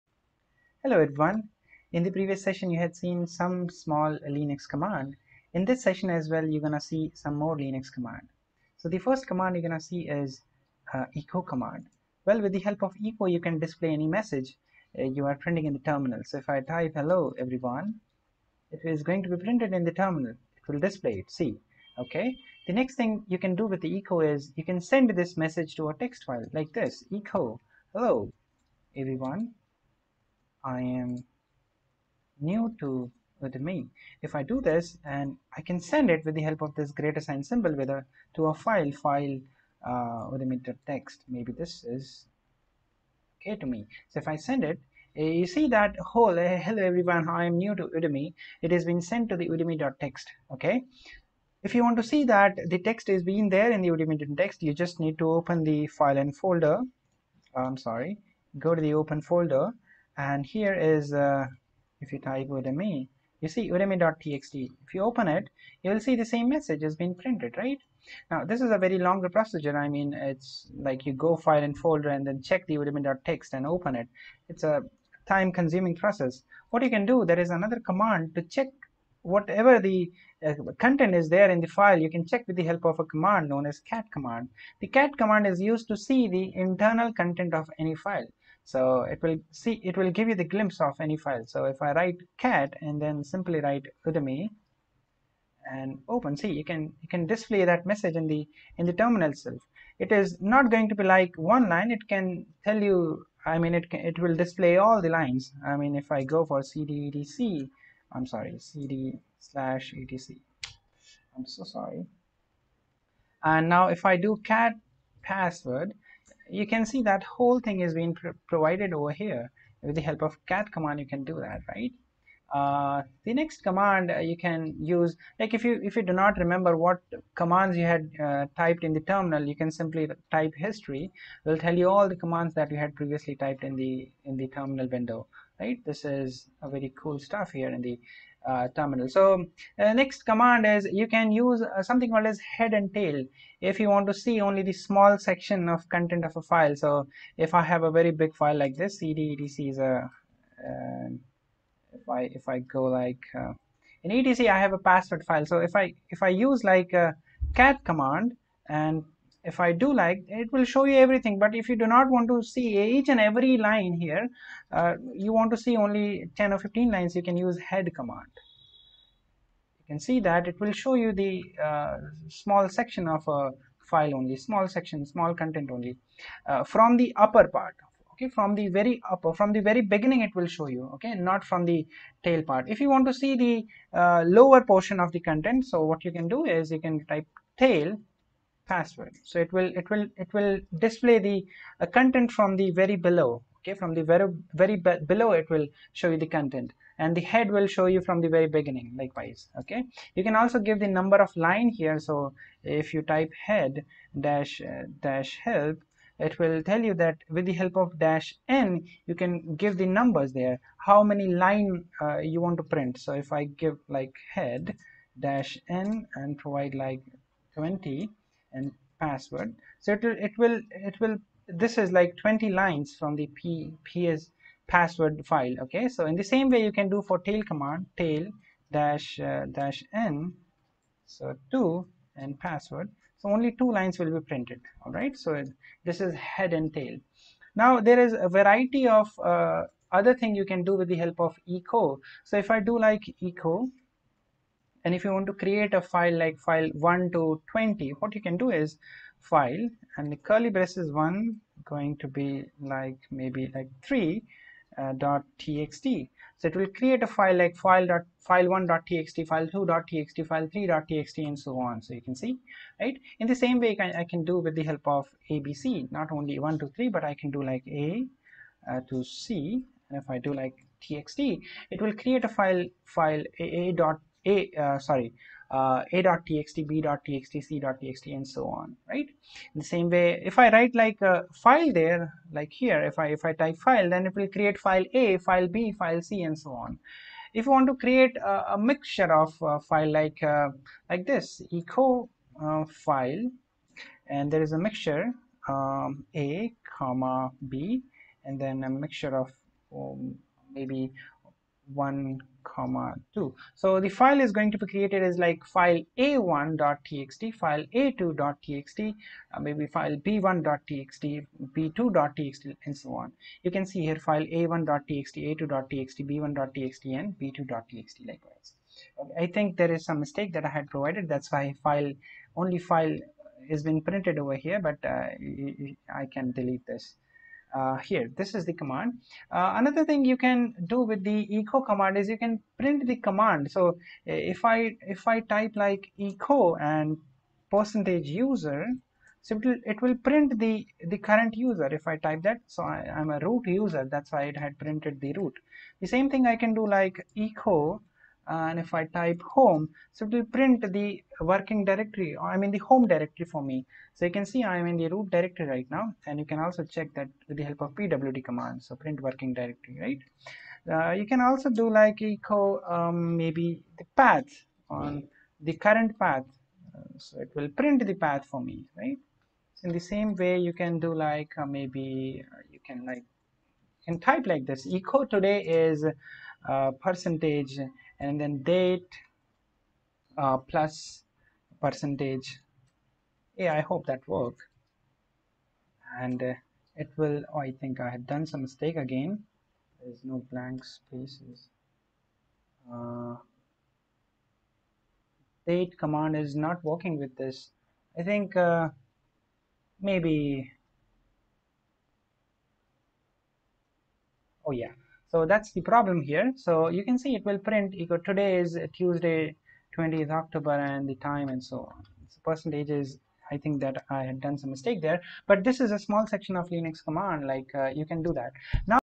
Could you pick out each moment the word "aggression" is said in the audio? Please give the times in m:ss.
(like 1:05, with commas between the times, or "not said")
not said.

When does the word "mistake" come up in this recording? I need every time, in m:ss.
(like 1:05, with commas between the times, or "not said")
5:19, 6:28, 6:54.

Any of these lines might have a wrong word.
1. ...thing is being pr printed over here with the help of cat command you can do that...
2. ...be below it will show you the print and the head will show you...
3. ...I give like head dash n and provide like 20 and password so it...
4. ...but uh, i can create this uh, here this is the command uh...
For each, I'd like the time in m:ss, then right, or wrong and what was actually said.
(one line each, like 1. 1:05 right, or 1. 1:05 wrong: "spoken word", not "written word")
1. 1:57 wrong: "provided", not "printed"
2. 3:14 wrong: "content", not "print"
3. 3:33 right
4. 5:24 wrong: "delete", not "create".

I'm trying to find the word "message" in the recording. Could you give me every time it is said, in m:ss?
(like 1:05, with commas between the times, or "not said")
0:14, 0:25, 1:06, 1:37.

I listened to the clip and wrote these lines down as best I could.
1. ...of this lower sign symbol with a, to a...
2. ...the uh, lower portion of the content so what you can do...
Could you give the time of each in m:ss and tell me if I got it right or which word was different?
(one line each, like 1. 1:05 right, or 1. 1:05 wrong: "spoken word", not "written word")
1. 0:36 wrong: "greater", not "lower"
2. 3:03 right.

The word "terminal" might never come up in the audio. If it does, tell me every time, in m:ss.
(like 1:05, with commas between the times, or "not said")
0:15, 0:19, 1:38, 2:08, 2:14, 2:18.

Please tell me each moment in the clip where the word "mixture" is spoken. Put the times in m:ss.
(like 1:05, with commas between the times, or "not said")
4:48, 4:54, 4:58.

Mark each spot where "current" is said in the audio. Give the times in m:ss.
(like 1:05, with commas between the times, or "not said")
5:40, 6:05.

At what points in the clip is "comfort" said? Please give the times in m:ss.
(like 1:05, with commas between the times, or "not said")
not said.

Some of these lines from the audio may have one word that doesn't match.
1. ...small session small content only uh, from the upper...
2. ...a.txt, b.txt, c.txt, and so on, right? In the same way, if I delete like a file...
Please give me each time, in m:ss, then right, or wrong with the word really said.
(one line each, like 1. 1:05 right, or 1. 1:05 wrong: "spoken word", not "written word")
1. 2:54 wrong: "section", not "session"
2. 4:35 wrong: "write", not "delete".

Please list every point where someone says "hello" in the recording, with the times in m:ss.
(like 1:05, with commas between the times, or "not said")
0:00, 0:16, 0:27, 0:46.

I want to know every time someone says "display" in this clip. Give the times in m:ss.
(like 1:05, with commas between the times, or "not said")
0:13, 0:20, 1:37, 1:44, 3:10.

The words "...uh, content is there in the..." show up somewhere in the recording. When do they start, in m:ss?
1:20.